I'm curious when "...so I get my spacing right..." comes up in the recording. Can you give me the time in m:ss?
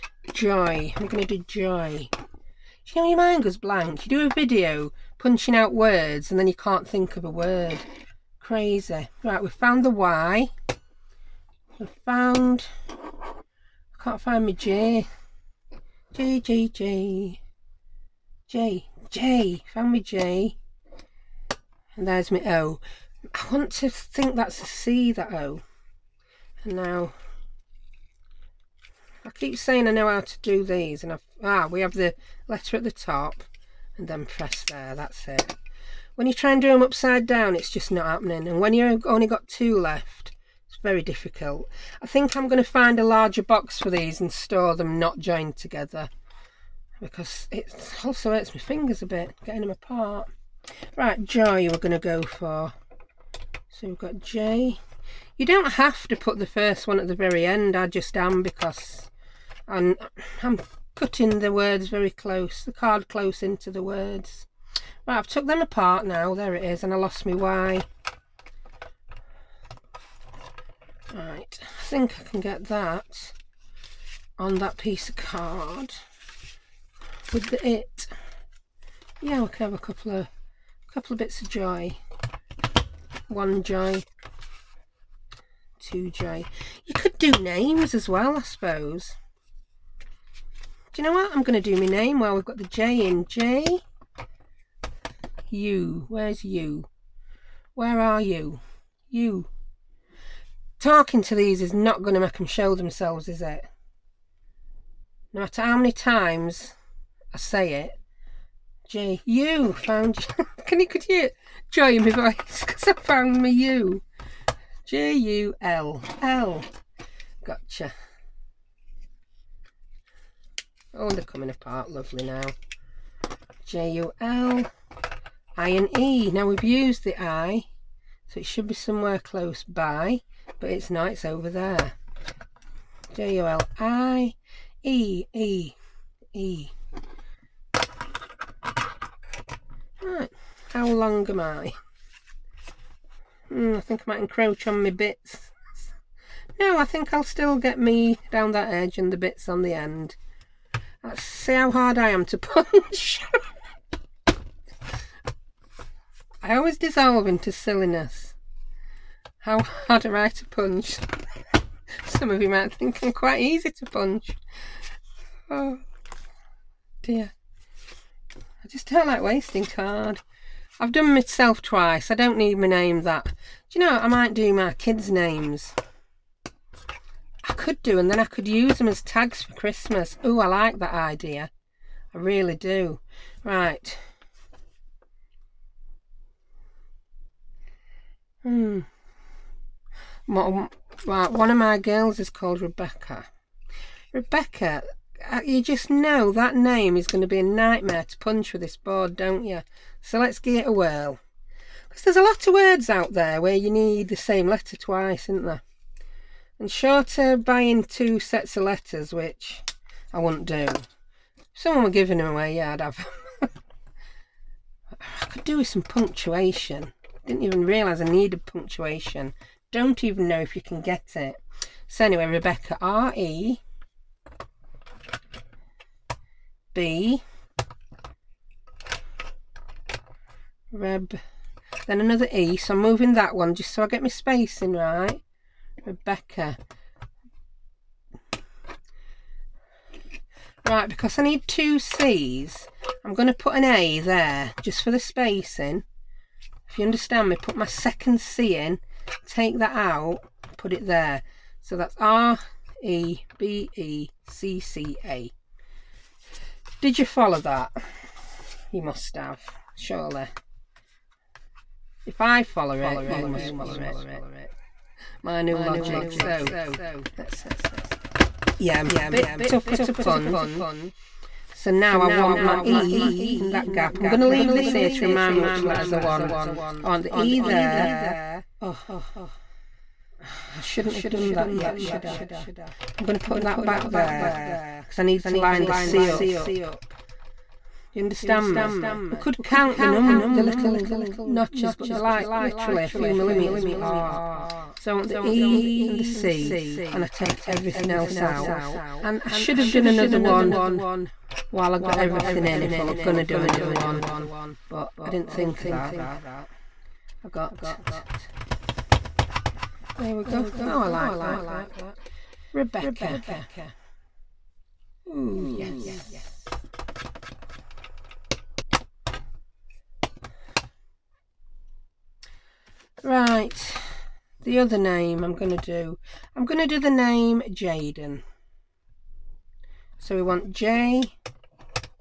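3:53.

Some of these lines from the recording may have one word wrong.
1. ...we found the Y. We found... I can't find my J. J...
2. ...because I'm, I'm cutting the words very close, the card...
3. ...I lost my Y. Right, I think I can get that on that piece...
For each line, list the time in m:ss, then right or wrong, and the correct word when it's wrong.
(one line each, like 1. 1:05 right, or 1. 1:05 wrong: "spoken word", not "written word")
1. 0:09 right
2. 0:58 right
3. 1:06 right.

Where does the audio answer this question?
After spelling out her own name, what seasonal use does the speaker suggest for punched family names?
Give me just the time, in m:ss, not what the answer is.
2:59.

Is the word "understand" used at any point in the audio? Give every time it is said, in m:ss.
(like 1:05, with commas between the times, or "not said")
4:06, 4:48.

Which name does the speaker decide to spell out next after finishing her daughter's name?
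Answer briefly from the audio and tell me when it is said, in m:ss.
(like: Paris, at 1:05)
Jayden, at 5:27.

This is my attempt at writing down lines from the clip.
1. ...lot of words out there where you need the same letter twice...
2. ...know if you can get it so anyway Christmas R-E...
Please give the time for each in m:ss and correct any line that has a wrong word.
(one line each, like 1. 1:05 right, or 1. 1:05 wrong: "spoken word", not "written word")
1. 3:22 right
2. 3:40 wrong: "Rebecca", not "Christmas".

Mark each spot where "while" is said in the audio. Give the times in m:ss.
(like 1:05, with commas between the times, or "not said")
1:32, 5:01.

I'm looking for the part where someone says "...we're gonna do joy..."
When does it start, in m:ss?
0:01.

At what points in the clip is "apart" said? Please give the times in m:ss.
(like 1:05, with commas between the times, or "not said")
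0:49, 1:05, 2:01, 4:53.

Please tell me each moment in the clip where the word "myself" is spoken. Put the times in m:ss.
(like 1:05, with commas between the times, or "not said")
2:51.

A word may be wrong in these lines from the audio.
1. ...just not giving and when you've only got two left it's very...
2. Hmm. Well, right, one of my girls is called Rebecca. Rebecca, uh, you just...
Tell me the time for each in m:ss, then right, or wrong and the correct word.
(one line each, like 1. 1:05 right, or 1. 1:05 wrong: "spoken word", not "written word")
1. 0:37 wrong: "happening", not "giving"
2. 3:08 right.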